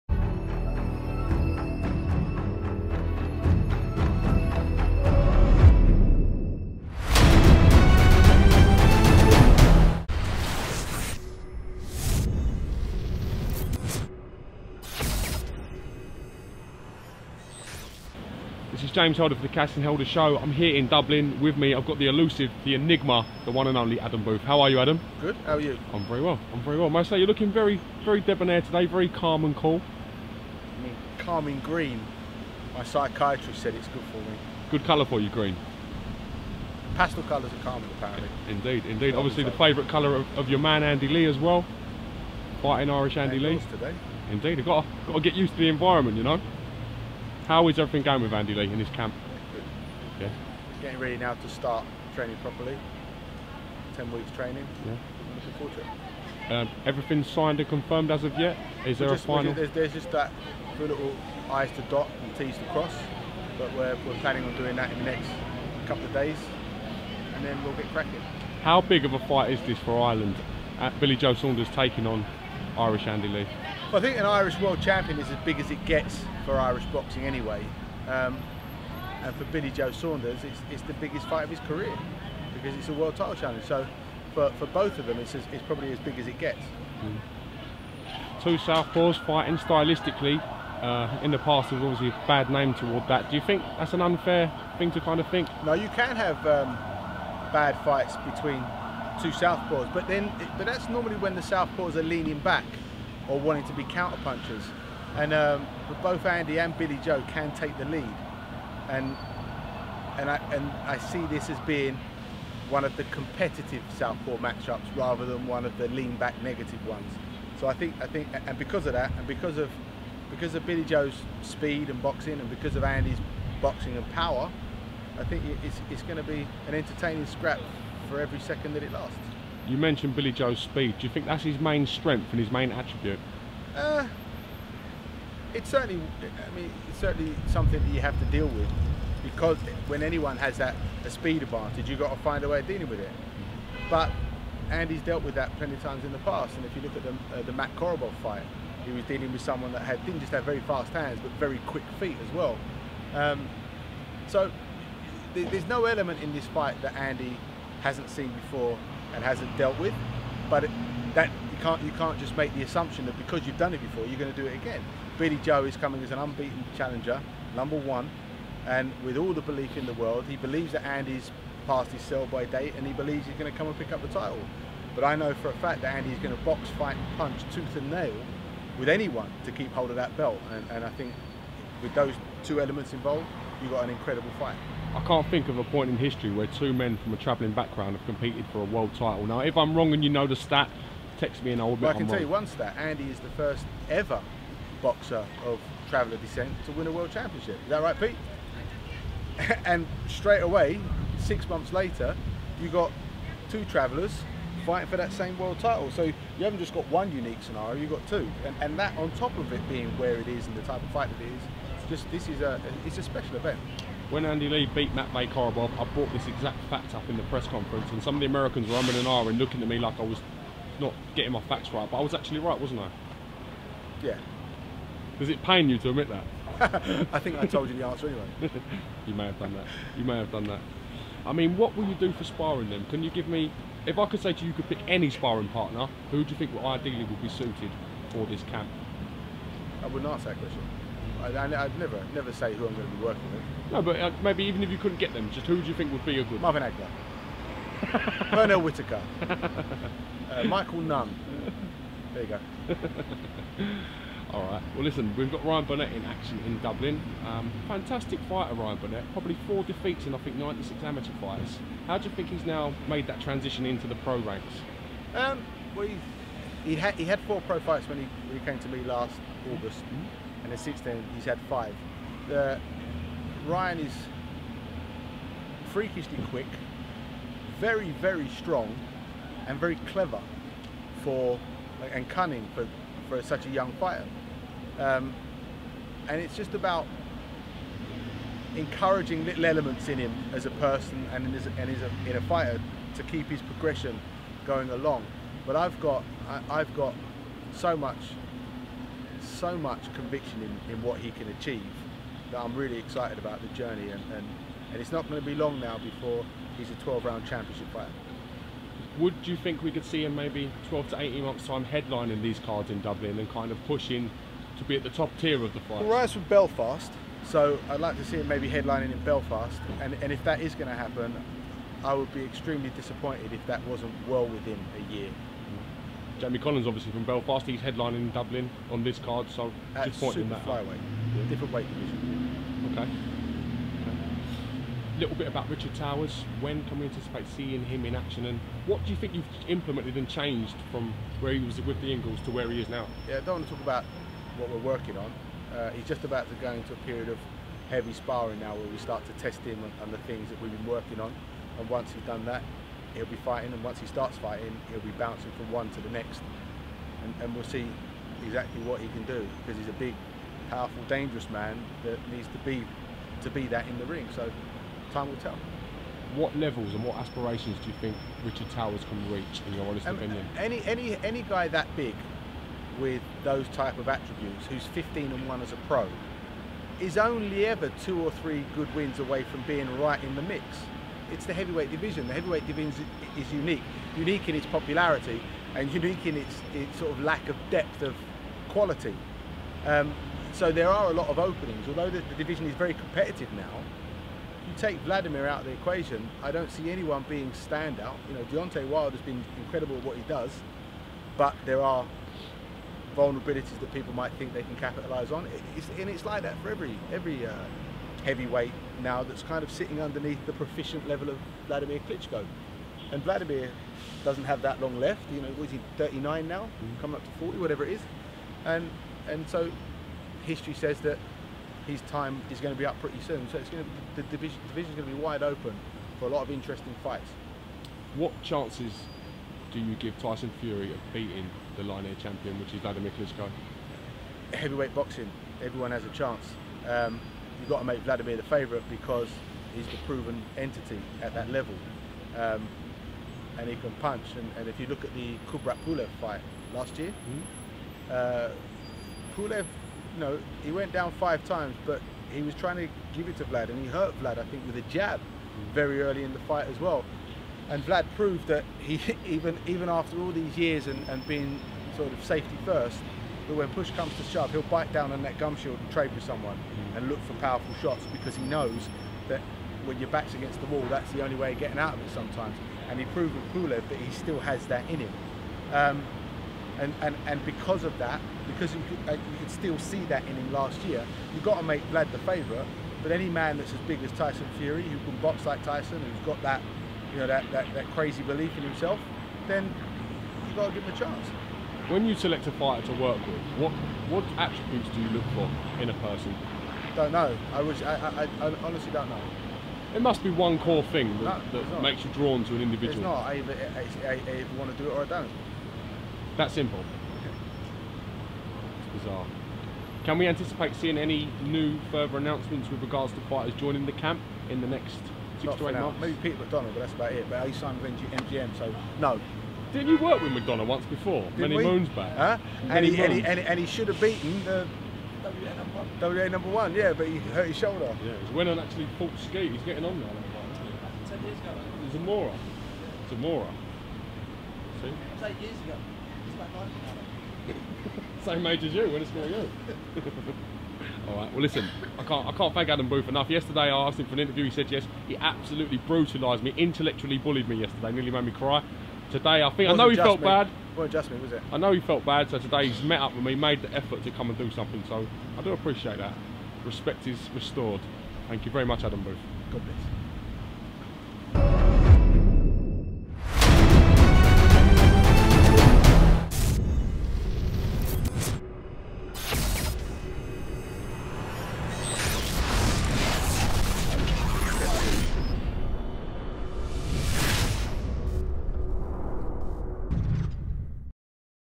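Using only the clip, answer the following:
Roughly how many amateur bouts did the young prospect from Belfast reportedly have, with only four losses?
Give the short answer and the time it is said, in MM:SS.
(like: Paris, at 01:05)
96, at 04:20.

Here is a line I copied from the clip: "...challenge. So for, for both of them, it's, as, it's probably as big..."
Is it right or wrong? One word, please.
right.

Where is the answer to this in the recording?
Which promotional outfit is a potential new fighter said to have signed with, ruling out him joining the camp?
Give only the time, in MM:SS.
08:37.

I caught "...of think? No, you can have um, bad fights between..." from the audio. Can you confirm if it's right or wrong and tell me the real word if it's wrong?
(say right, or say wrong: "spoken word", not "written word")
right.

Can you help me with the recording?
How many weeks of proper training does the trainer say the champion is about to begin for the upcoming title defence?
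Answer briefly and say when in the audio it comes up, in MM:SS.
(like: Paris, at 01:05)
10, at 00:53.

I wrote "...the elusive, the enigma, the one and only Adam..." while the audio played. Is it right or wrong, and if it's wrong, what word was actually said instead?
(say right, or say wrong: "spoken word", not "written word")
right.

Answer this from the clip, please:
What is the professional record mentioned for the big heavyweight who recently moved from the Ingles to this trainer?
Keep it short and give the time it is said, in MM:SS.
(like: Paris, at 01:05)
15 and 1, at 06:14.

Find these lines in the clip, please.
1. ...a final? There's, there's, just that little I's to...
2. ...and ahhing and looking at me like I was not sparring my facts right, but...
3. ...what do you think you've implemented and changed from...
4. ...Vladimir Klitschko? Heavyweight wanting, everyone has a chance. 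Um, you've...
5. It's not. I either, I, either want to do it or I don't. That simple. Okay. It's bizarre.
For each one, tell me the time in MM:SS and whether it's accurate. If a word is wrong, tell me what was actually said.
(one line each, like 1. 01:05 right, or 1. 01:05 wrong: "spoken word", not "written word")
1. 00:59 right
2. 03:38 wrong: "getting", not "sparring"
3. 05:38 right
4. 07:12 wrong: "boxing", not "wanting"
5. 08:22 right.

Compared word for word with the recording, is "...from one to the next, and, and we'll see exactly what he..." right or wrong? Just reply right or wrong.
right.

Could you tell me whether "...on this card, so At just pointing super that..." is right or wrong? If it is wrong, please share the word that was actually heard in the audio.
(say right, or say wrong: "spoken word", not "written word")
right.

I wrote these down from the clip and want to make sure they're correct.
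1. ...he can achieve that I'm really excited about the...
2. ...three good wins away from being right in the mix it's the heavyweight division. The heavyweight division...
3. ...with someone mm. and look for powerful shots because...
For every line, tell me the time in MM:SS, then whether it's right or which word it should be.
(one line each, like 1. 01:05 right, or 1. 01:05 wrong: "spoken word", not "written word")
1. 05:00 right
2. 06:18 right
3. 07:45 right.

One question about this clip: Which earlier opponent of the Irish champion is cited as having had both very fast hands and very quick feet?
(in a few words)
Matt Korobov.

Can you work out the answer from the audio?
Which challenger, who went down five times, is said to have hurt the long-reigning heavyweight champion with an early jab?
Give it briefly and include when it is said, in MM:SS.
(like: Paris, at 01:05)
Kubrat Pulev, at 07:25.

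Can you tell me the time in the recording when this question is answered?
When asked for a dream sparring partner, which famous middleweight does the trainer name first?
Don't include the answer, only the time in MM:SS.
04:06.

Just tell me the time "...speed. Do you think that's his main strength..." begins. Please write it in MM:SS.
02:10.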